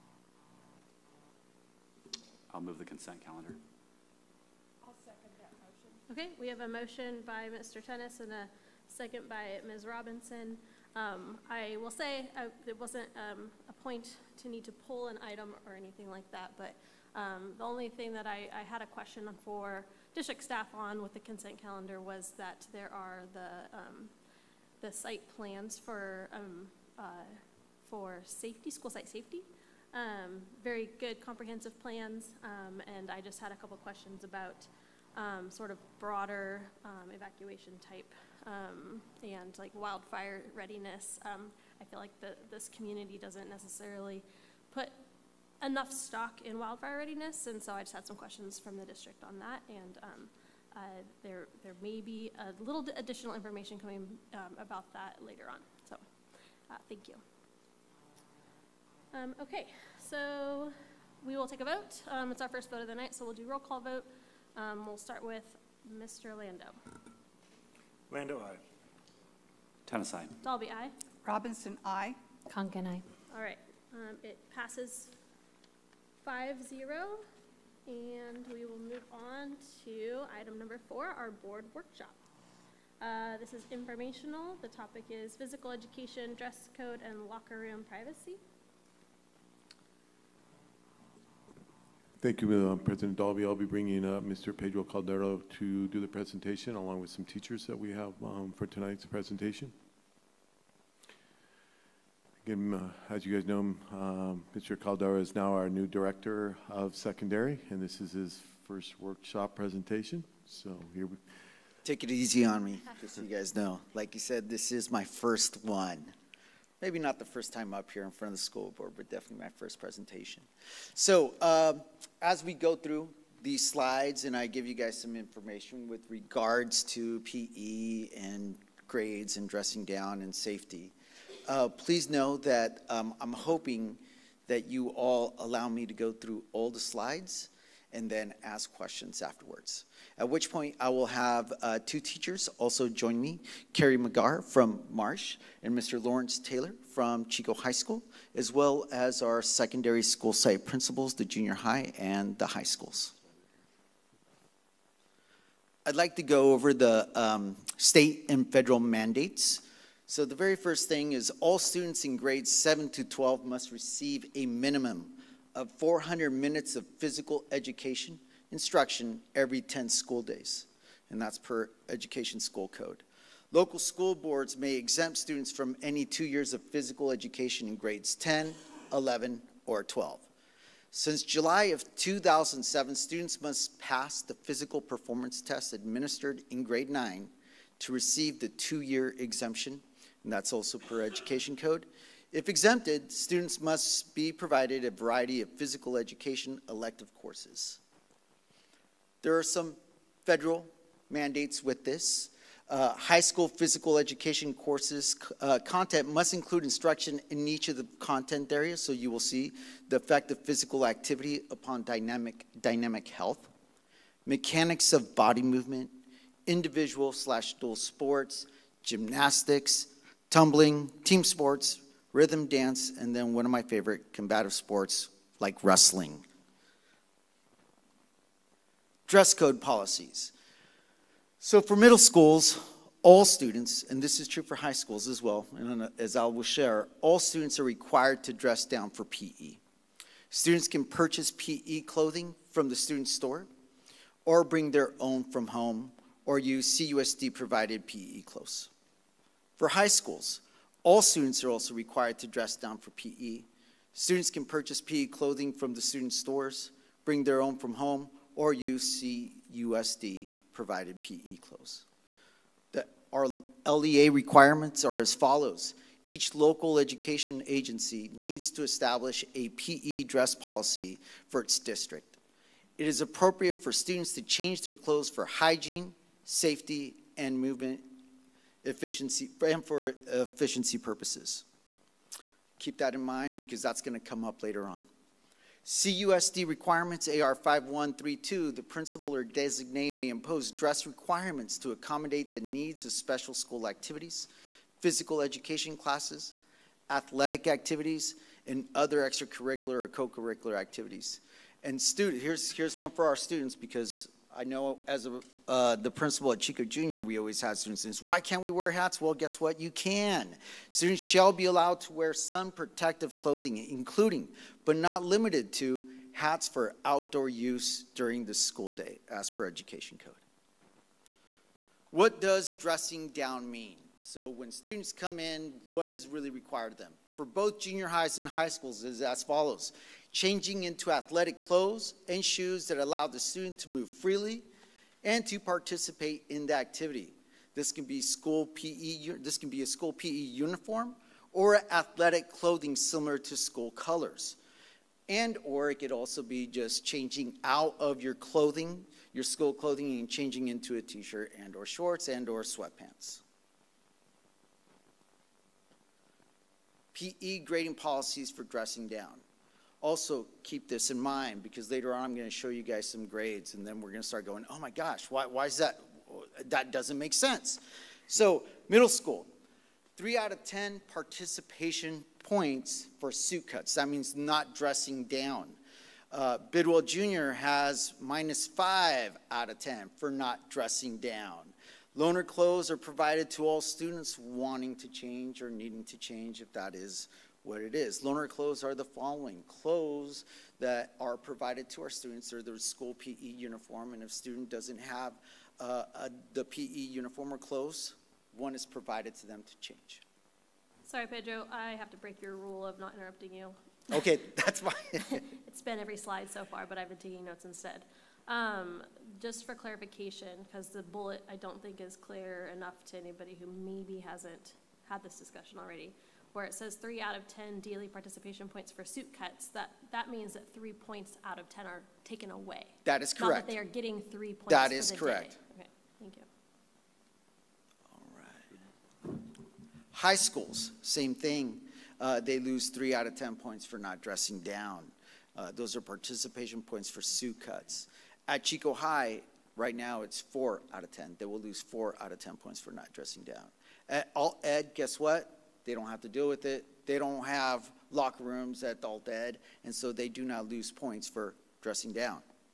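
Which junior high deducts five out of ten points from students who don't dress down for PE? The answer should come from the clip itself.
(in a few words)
Bidwell Jr.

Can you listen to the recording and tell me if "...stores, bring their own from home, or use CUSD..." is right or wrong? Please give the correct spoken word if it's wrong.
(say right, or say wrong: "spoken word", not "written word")
right.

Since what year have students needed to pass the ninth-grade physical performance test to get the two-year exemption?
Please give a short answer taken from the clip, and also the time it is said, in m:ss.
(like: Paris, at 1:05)
2007, at 3:01.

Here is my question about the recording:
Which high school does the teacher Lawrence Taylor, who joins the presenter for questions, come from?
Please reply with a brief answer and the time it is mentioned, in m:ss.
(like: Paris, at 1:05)
Chico High School, at 2:27.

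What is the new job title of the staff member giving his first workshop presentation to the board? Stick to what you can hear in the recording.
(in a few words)
director of secondary.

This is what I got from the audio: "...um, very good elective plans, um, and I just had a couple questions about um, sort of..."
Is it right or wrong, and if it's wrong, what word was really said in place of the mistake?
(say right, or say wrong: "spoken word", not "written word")
wrong: "comprehensive", not "elective".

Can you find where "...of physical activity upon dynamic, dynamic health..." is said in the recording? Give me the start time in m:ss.
3:30.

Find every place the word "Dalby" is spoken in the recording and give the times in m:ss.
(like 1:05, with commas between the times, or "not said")
1:10, 1:33.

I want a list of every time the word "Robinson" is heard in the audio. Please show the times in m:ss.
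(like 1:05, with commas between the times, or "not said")
0:09, 1:11.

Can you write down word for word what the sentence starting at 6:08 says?
So, middle school, three out of 10 participation points for suit cuts.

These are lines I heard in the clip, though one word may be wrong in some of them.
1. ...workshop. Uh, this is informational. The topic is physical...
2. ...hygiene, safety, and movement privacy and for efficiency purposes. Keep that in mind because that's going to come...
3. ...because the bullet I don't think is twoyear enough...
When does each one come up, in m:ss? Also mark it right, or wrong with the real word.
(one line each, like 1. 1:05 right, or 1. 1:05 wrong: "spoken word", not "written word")
1. 1:21 right
2. 4:35 wrong: "efficiency", not "privacy"
3. 6:50 wrong: "clear", not "twoyear".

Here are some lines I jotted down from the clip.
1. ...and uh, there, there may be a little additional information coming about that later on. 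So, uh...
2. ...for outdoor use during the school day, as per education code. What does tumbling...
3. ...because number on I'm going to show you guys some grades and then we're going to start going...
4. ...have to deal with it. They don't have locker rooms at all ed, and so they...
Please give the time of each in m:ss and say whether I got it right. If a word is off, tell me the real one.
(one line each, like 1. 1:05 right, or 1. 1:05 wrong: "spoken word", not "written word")
1. 0:49 right
2. 5:16 wrong: "dressing", not "tumbling"
3. 6:01 wrong: "later", not "number"
4. 7:25 right.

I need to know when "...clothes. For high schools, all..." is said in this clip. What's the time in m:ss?
4:08.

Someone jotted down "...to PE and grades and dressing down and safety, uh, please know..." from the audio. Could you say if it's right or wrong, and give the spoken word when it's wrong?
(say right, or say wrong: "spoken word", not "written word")
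right.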